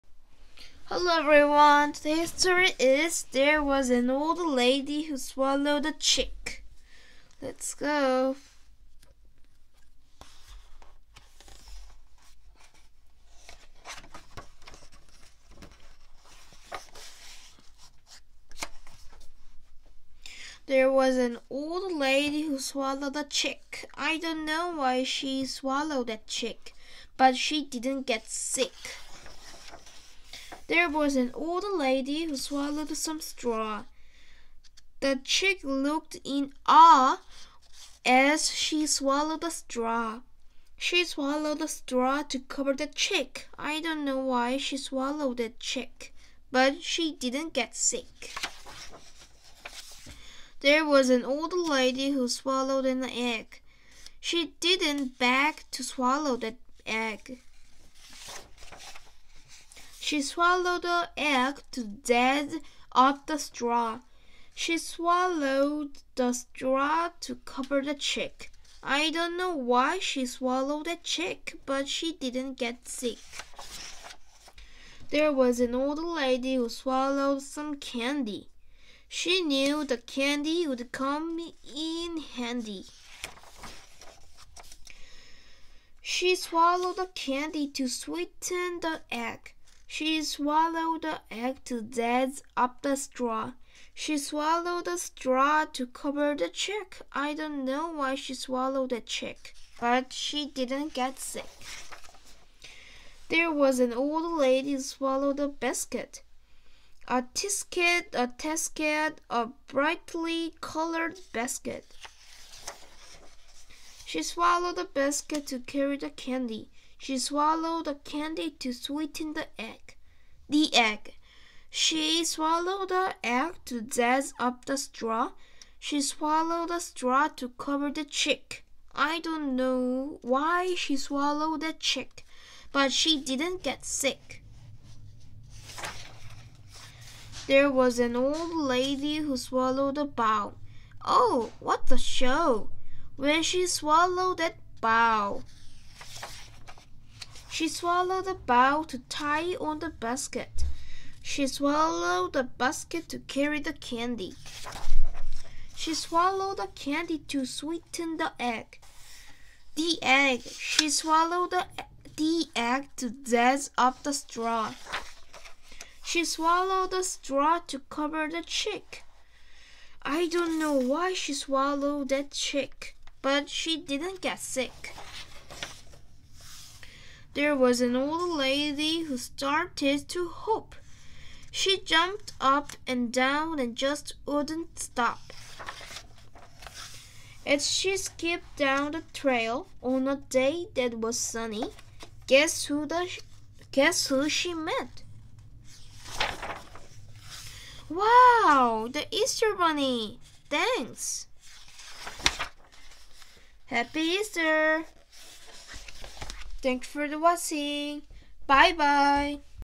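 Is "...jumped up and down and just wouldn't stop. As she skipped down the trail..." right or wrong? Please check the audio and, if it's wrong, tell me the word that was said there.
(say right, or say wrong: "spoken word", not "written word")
right.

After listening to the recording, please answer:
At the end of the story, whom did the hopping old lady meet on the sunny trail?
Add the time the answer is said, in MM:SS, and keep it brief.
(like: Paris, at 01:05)
The Easter bunny, at 03:18.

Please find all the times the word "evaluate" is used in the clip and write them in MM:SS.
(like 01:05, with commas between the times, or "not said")
not said.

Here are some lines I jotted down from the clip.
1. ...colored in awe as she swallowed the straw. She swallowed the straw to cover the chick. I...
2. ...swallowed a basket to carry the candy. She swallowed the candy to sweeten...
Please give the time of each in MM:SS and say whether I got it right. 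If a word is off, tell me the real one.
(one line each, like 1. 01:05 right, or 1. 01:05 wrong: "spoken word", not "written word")
1. 00:35 wrong: "looked", not "colored"
2. 02:31 right.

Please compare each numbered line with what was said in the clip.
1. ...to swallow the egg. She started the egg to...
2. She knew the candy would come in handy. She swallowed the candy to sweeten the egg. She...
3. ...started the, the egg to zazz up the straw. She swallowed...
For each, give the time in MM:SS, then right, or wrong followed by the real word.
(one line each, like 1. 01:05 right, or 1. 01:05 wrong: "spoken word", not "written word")
1. 00:55 wrong: "swallowed", not "started"
2. 01:19 right
3. 02:40 wrong: "swallowed", not "started".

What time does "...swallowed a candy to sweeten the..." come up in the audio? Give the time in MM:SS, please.
01:57.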